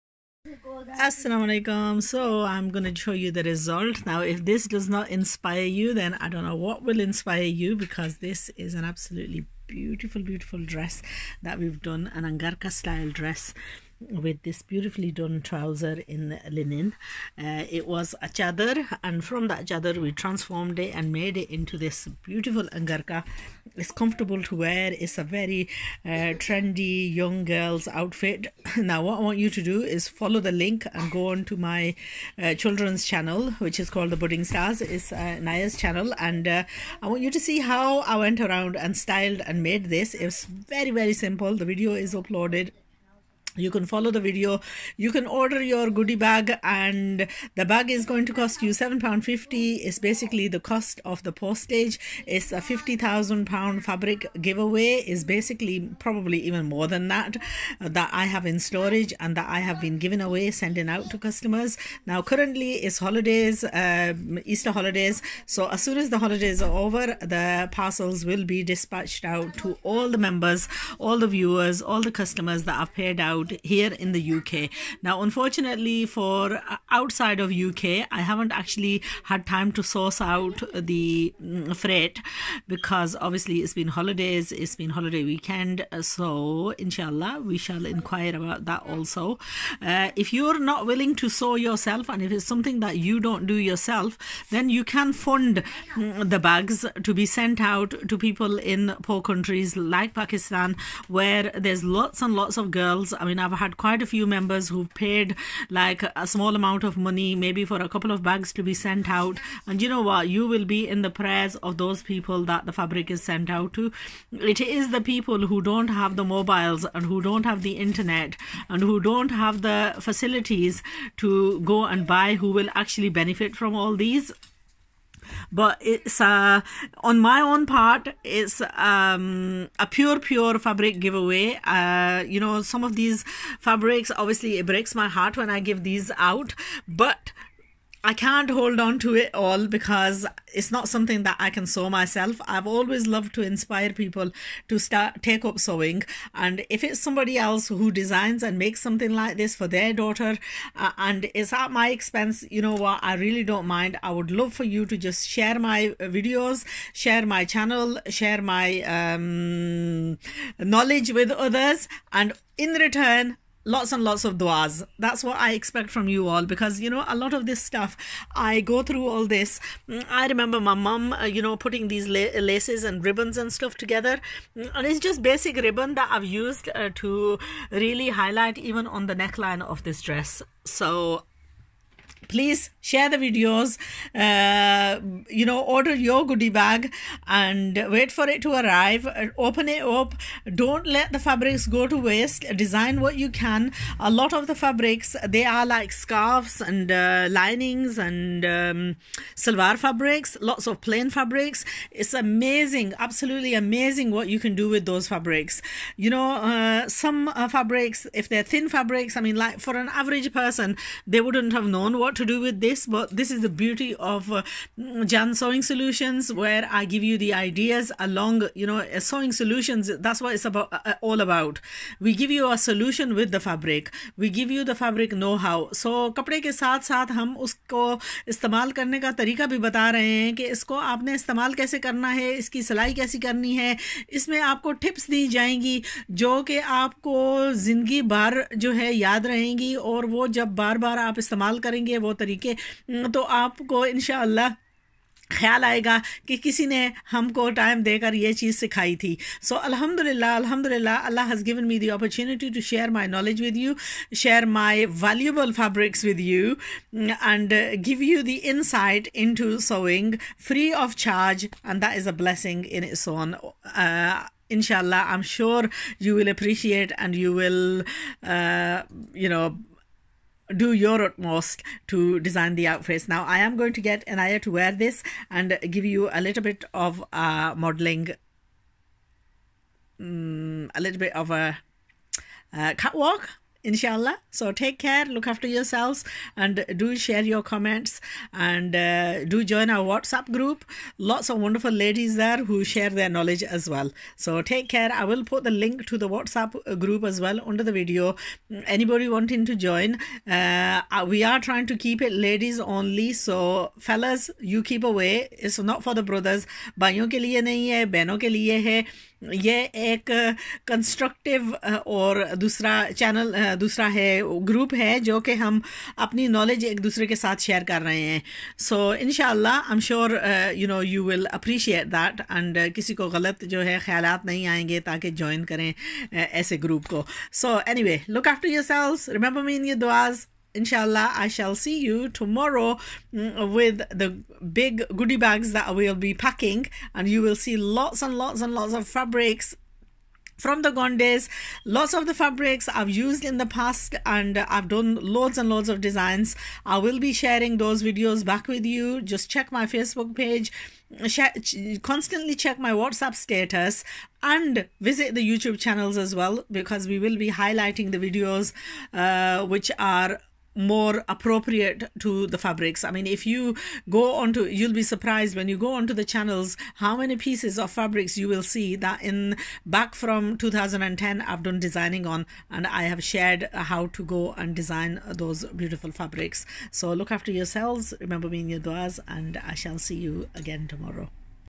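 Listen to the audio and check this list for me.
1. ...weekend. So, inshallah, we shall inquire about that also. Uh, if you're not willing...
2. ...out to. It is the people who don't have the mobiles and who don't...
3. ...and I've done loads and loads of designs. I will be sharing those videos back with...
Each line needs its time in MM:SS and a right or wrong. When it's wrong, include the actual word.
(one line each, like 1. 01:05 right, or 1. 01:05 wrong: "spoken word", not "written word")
1. 01:25 right
2. 01:53 right
3. 05:44 right.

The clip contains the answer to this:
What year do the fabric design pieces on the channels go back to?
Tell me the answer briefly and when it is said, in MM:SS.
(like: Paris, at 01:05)
2010, at 06:10.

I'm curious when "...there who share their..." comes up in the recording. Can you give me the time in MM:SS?
04:52.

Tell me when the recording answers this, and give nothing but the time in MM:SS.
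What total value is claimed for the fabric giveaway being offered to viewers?
00:52.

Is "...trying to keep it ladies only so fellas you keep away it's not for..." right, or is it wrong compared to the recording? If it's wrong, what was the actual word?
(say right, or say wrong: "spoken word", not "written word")
right.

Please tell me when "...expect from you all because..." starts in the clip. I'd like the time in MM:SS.
02:45.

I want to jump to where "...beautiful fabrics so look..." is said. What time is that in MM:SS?
06:15.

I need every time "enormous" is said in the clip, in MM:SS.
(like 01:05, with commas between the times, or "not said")
not said.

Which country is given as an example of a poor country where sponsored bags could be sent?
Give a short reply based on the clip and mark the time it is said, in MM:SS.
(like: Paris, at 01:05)
Pakistan, at 01:40.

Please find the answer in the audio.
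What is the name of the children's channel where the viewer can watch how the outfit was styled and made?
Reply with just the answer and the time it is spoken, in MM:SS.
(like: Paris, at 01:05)
The Budding Stars, at 00:34.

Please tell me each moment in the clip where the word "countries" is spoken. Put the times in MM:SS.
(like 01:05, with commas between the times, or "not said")
01:39.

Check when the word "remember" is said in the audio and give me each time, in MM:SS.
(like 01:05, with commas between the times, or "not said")
02:50, 06:18.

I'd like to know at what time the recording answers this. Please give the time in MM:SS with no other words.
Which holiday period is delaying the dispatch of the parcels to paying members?
01:04.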